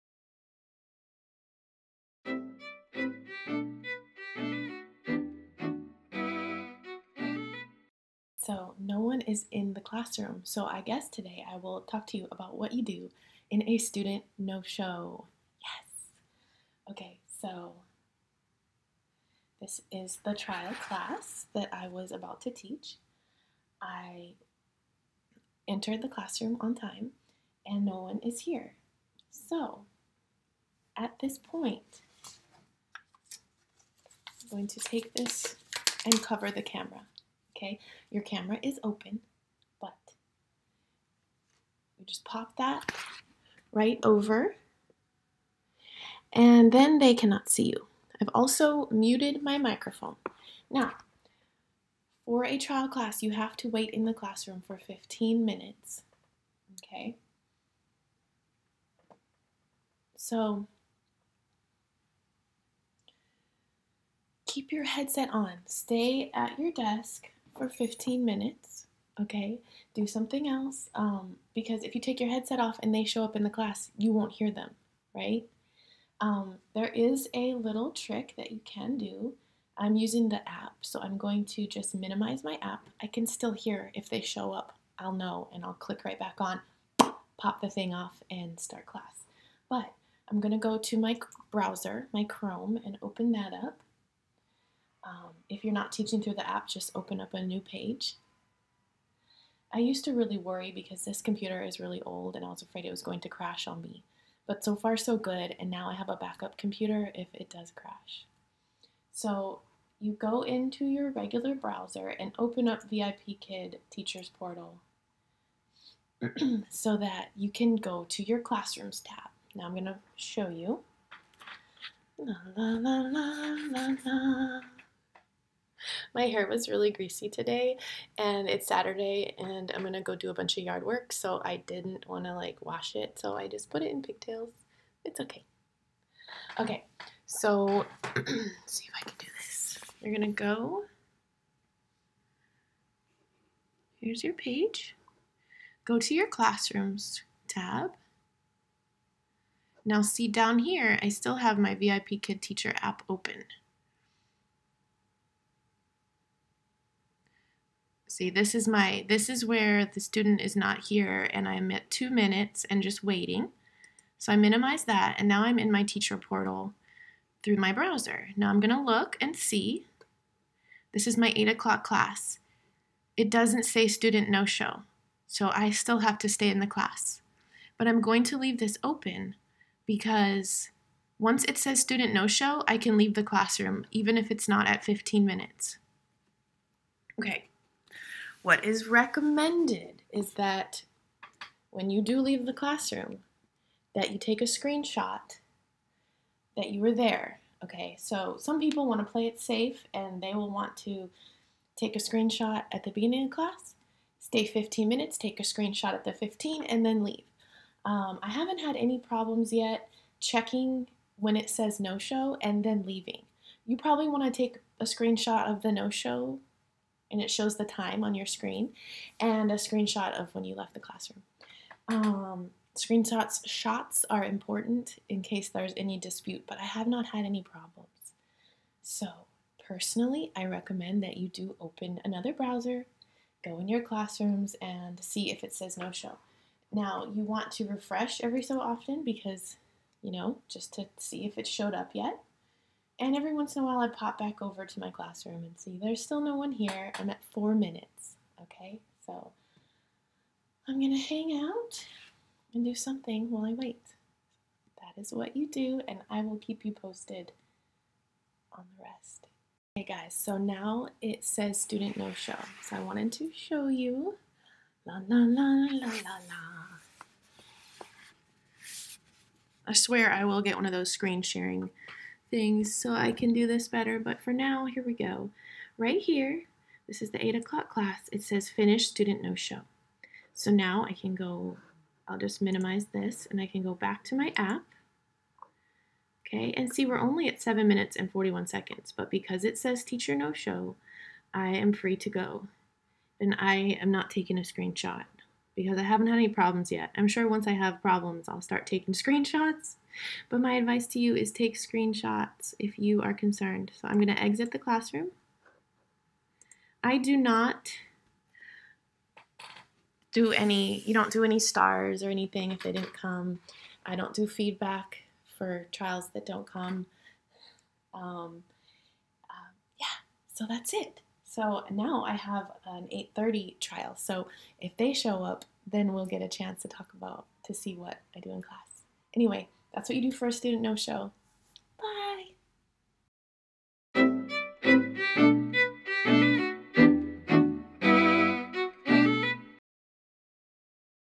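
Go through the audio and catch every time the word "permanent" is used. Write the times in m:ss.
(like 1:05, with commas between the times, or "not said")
not said.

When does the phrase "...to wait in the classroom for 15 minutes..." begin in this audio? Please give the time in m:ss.
0:53.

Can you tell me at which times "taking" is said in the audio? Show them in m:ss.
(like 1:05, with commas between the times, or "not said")
4:54, 4:58.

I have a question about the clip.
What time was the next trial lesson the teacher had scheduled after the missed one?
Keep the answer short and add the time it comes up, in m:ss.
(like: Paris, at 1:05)
8:30, at 5:23.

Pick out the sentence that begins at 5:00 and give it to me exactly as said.
But my advice to you is take screenshots if you are concerned.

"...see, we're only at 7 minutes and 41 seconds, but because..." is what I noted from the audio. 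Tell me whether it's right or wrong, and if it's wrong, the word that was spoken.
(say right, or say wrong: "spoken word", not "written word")
right.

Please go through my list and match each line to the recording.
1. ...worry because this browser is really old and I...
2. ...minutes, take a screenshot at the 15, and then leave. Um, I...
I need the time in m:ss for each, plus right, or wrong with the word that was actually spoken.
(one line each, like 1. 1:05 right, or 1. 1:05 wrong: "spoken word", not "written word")
1. 1:40 wrong: "computer", not "browser"
2. 3:24 right.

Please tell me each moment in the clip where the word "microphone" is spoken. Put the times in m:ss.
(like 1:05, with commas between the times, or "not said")
0:49.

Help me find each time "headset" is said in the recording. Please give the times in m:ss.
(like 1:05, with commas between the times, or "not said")
1:04, 1:12.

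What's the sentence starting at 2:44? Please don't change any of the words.
So I minimize that and now I'm in my teacher portal through my browser.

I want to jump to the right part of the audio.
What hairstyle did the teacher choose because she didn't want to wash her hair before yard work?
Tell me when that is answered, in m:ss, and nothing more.
2:14.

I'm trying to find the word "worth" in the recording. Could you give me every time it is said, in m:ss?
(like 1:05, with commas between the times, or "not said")
not said.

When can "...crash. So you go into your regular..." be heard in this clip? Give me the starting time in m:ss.
1:47.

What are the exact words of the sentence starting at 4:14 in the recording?
That is what you do, and I will keep you posted on the rest.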